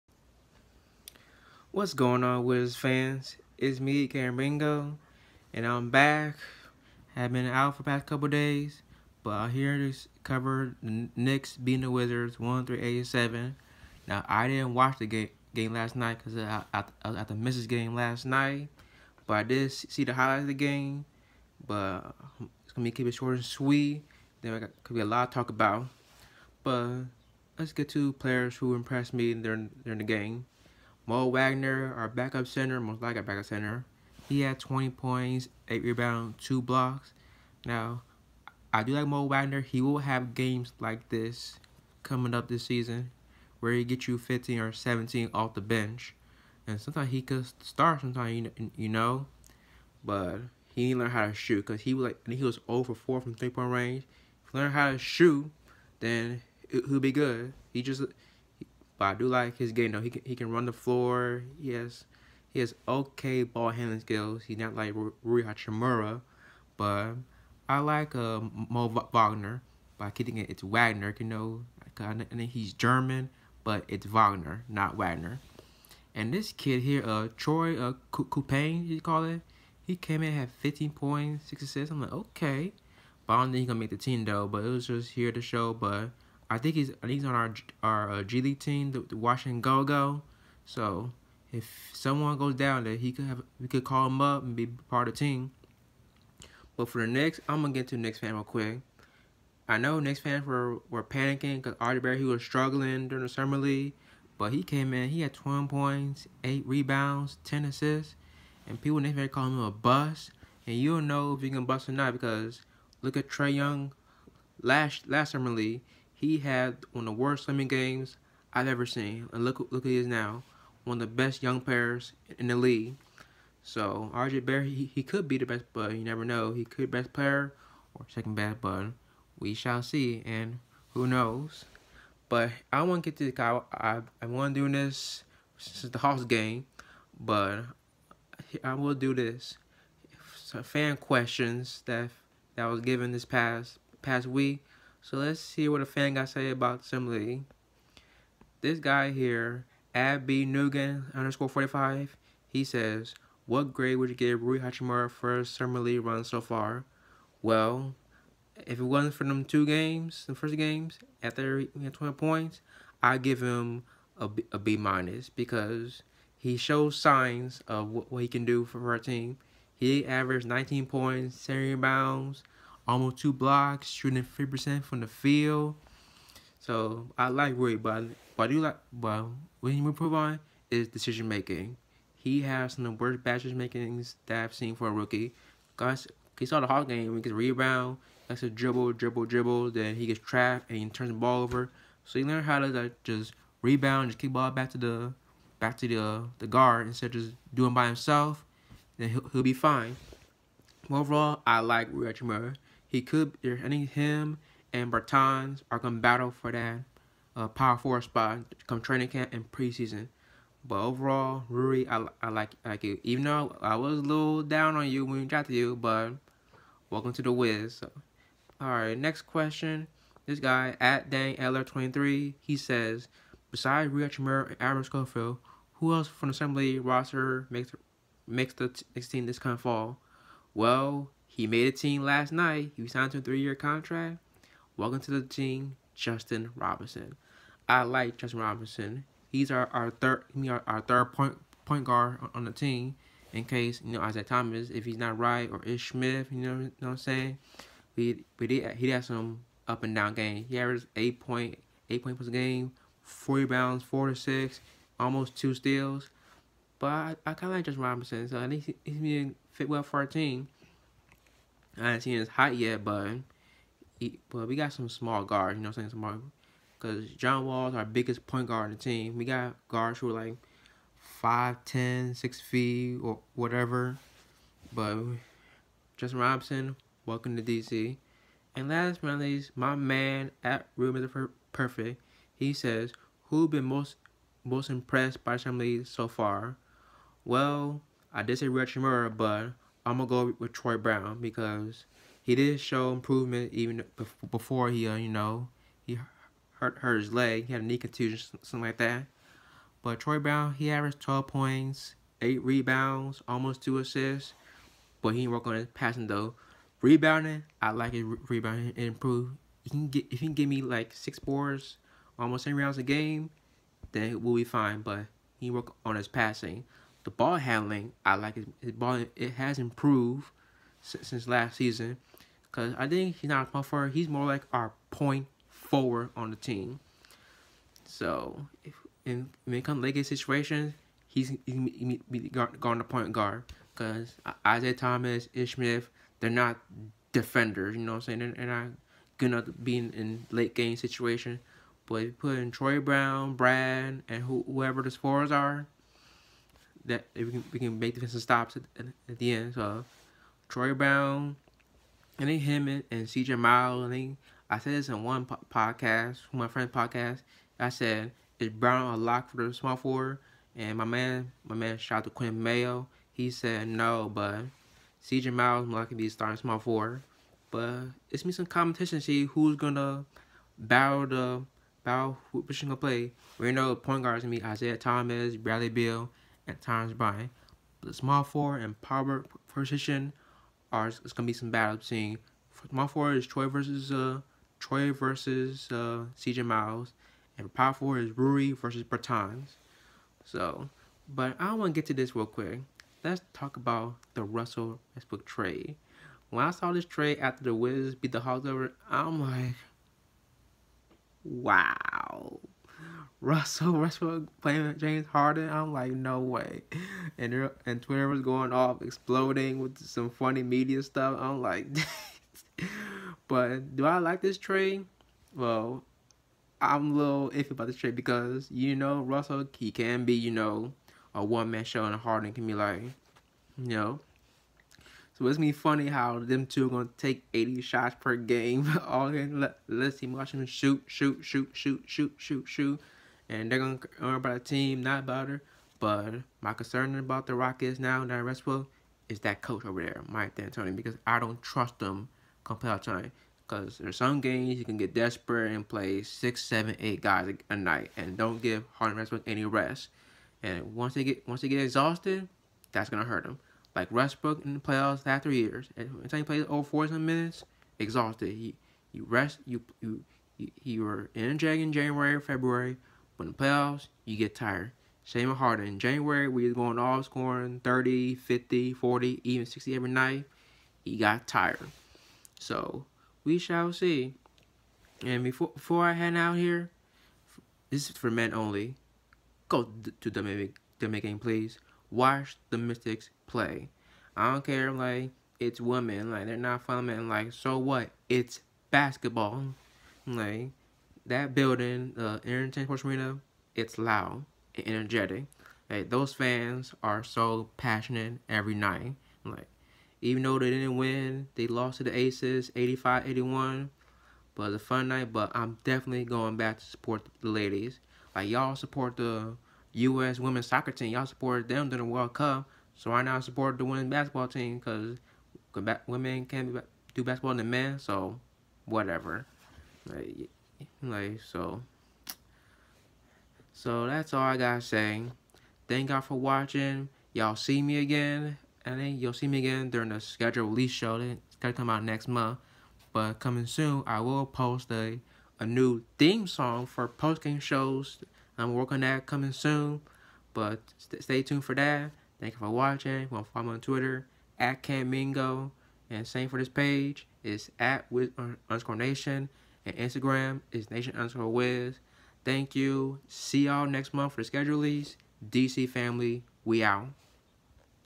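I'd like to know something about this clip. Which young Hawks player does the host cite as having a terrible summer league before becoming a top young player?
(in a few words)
Trae Young.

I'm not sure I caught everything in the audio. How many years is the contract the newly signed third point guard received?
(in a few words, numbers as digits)
3.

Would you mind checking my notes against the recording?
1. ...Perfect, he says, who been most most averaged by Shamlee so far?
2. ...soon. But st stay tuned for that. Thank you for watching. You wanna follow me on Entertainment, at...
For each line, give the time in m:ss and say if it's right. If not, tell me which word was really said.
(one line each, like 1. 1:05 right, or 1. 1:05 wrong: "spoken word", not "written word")
1. 4:41 wrong: "impressed", not "averaged"
2. 8:59 wrong: "Twitter", not "Entertainment".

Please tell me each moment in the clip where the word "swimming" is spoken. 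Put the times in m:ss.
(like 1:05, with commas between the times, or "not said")
1:57.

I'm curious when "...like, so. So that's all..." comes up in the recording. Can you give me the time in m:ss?
8:40.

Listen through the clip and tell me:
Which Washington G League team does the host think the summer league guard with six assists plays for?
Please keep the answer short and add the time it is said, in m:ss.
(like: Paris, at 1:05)
Washington Go Go, at 1:29.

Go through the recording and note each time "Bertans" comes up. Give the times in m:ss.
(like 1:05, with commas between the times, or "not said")
3:24, 6:28.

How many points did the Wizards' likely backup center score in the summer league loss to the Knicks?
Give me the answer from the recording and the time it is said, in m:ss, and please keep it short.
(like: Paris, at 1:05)
20, at 0:34.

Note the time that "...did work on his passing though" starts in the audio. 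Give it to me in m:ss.
5:05.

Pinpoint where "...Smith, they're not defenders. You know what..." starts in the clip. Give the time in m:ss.
5:35.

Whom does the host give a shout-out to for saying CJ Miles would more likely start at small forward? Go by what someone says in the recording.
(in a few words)
Quinn Mayo.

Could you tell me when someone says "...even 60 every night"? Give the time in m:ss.
7:49.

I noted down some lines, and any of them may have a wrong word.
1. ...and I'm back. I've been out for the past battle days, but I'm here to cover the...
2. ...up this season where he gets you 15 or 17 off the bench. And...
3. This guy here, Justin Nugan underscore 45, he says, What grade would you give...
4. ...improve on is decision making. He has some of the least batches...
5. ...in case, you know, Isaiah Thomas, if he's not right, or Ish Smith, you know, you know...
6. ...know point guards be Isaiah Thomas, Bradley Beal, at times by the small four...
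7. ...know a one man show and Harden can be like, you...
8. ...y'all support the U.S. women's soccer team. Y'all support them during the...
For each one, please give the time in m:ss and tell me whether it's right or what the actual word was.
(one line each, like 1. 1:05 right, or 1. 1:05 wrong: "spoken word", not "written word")
1. 0:05 wrong: "couple", not "battle"
2. 0:42 right
3. 2:28 wrong: "Abby", not "Justin"
4. 2:59 wrong: "worst", not "least"
5. 4:03 right
6. 6:13 right
7. 7:00 right
8. 8:28 right.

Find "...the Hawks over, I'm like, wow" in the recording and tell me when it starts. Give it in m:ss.
6:38.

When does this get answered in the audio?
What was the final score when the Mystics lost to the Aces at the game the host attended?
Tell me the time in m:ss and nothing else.
8:22.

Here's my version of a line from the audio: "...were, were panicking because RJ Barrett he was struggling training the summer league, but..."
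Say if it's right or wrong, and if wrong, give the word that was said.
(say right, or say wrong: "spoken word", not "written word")
wrong: "during", not "training".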